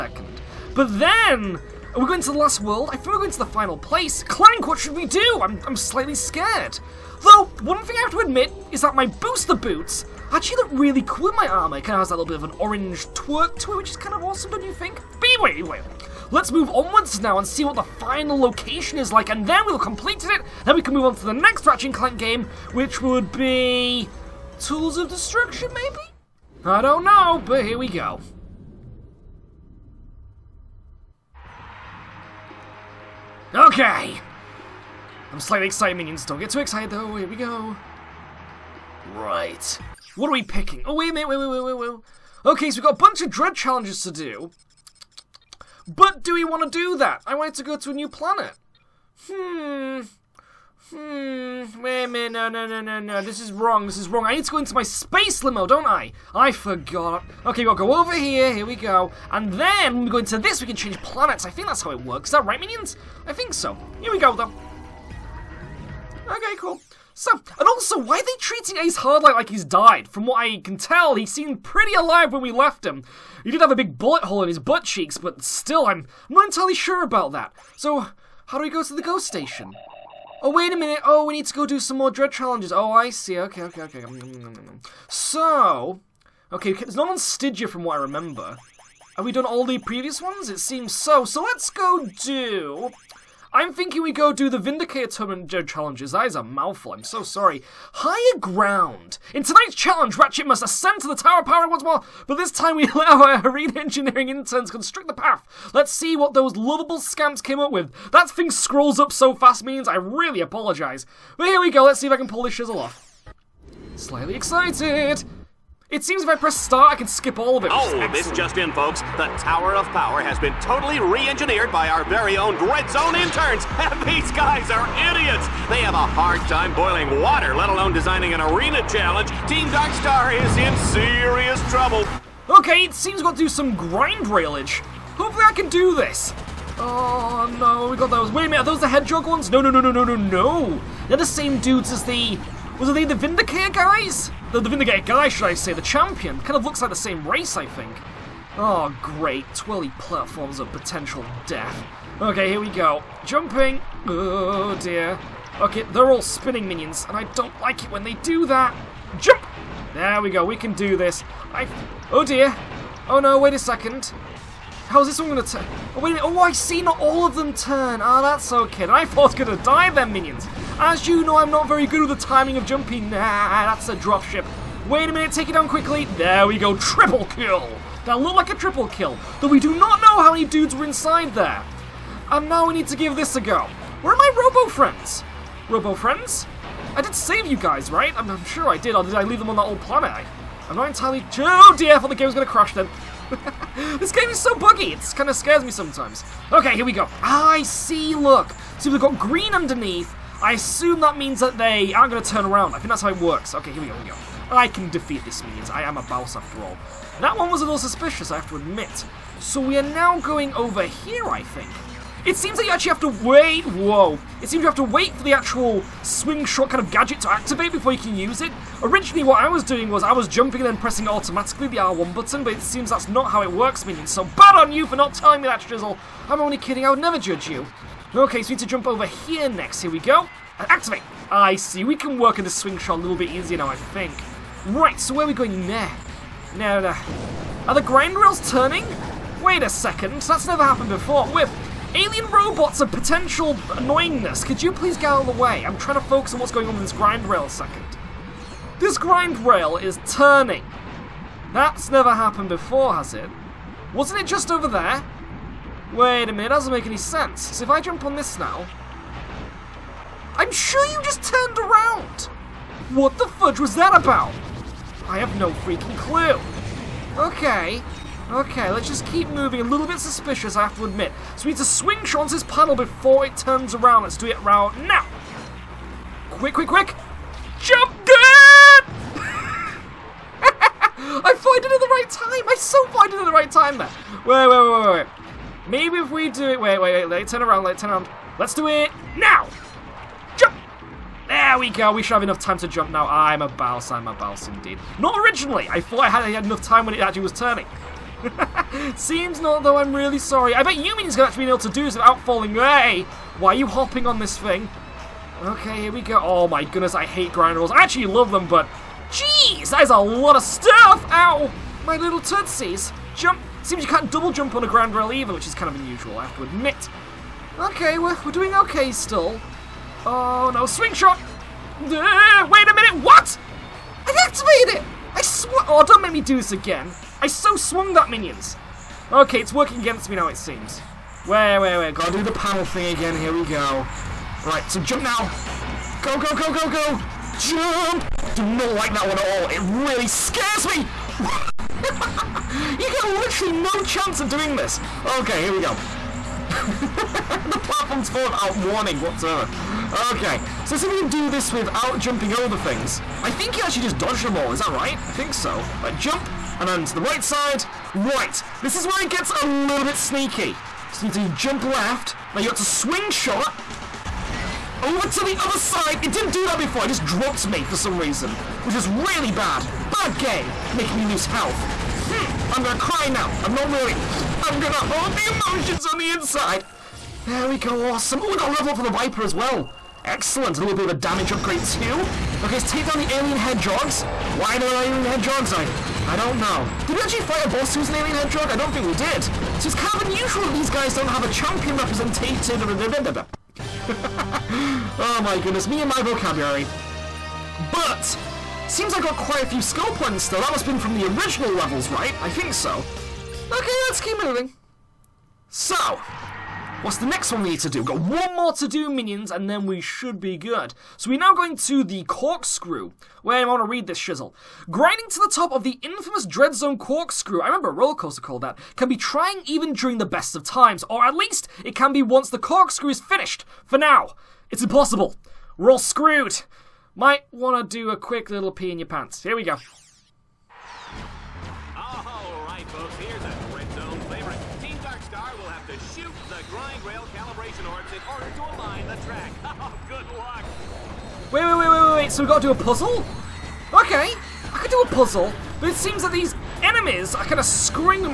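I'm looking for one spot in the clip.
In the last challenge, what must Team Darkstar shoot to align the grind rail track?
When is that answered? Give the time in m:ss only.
7:17.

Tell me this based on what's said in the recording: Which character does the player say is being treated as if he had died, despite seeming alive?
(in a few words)
Ace Hardlight.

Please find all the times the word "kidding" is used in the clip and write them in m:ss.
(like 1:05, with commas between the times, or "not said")
3:46.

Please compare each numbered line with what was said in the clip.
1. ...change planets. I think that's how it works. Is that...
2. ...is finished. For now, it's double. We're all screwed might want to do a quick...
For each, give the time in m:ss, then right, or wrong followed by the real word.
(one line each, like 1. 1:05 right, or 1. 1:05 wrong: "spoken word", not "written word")
1. 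1:00 right
2. 7:02 wrong: "impossible", not "double".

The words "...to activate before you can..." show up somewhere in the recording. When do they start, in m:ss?
3:37.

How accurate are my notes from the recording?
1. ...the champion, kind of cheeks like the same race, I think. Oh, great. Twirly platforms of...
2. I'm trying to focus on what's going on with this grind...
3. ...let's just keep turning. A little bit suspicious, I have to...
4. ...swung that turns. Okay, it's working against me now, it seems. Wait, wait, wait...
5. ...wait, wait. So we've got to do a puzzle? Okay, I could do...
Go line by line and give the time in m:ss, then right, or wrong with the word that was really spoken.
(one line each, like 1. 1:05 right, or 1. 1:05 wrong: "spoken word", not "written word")
1. 2:25 wrong: "looks", not "cheeks"
2. 4:05 right
3. 4:28 wrong: "moving", not "turning"
4. 5:27 wrong: "minions", not "turns"
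5. 7:21 right.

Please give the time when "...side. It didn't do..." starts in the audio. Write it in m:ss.
6:05.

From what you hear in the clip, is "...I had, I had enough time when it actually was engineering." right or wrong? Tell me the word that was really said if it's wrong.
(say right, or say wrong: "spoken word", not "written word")
wrong: "turning", not "engineering".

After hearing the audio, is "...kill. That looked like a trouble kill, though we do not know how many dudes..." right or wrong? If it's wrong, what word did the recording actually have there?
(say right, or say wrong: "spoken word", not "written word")
wrong: "triple", not "trouble".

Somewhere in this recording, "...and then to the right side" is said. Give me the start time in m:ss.
5:56.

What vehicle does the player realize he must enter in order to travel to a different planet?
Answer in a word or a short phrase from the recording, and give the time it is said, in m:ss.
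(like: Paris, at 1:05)
space limo, at 0:54.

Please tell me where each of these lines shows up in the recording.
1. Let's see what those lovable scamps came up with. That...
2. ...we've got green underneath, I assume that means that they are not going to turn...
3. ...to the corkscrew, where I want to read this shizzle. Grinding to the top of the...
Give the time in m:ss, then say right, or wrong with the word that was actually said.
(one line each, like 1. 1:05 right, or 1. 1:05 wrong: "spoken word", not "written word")
1. 1:45 right
2. 3:18 right
3. 6:51 right.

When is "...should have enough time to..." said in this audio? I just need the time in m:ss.
4:52.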